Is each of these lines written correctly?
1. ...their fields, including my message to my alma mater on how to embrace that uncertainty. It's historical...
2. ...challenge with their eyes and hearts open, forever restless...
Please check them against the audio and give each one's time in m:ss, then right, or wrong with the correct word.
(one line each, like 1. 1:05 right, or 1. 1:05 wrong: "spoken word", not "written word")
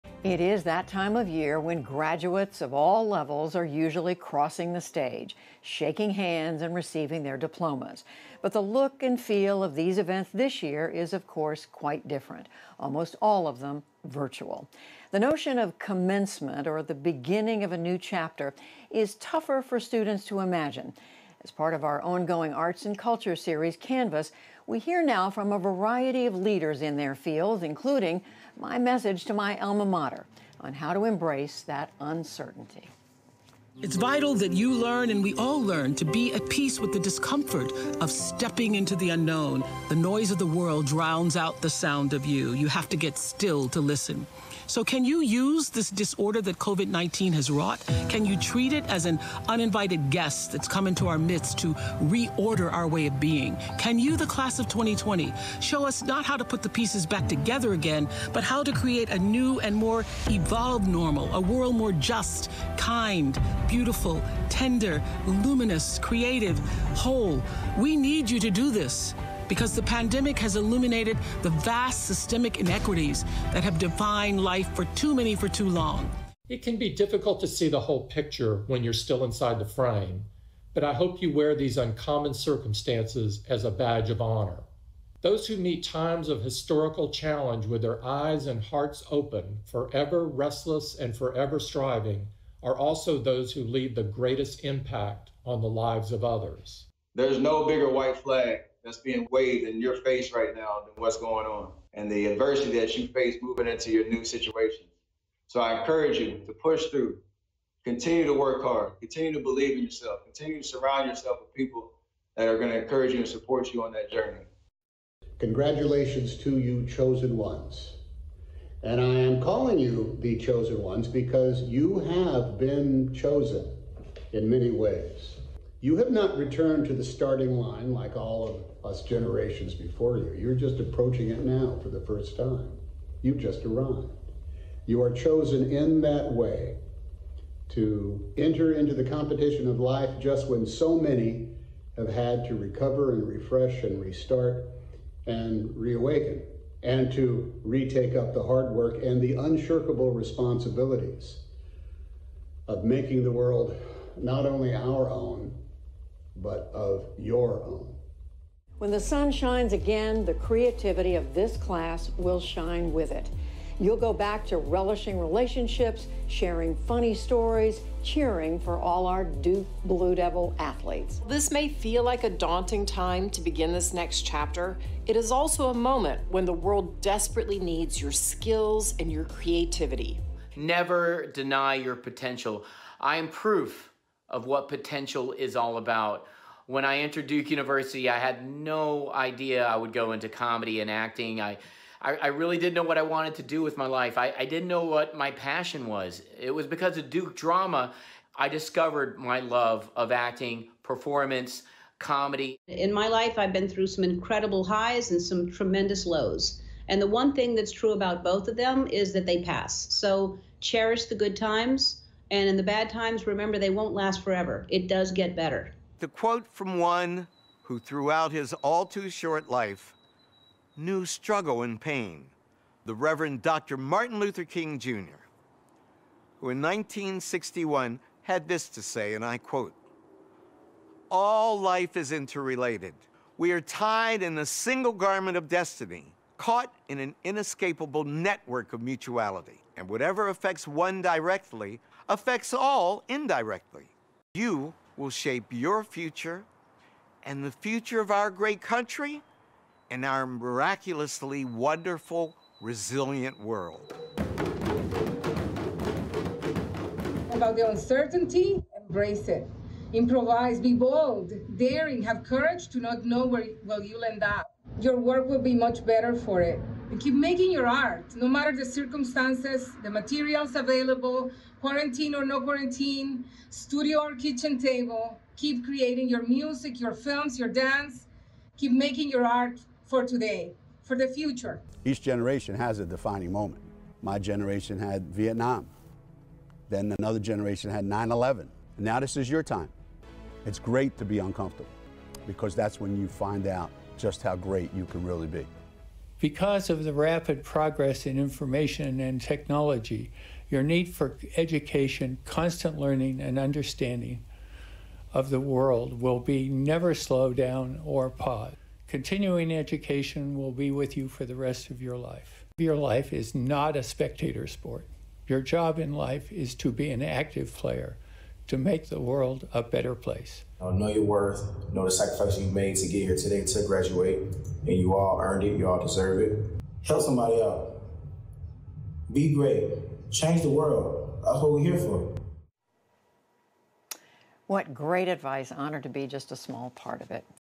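1. 0:26 wrong: "vital", not "historical"
2. 1:27 right.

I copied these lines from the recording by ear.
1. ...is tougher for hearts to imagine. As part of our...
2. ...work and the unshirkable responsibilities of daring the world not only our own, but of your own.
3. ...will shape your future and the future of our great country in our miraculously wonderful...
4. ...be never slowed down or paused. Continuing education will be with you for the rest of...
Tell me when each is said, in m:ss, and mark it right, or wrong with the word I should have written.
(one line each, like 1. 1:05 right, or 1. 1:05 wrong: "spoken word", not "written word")
1. 0:18 wrong: "students", not "hearts"
2. 2:28 wrong: "making", not "daring"
3. 4:04 right
4. 5:06 right.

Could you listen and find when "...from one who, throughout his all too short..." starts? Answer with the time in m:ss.
3:36.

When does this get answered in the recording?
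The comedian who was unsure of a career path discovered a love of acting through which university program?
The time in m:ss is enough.
3:17.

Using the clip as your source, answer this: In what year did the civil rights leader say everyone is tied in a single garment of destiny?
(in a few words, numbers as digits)
1961.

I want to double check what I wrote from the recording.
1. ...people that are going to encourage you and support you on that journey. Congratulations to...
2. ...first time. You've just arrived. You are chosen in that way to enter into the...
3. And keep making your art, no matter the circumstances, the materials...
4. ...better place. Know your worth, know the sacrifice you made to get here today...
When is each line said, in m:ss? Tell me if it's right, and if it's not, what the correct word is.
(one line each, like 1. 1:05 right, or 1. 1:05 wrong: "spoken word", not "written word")
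1. 1:51 right
2. 2:12 right
3. 4:26 right
4. 5:19 right.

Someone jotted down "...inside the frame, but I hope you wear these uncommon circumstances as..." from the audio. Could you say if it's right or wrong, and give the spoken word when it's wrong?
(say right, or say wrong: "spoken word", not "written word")
right.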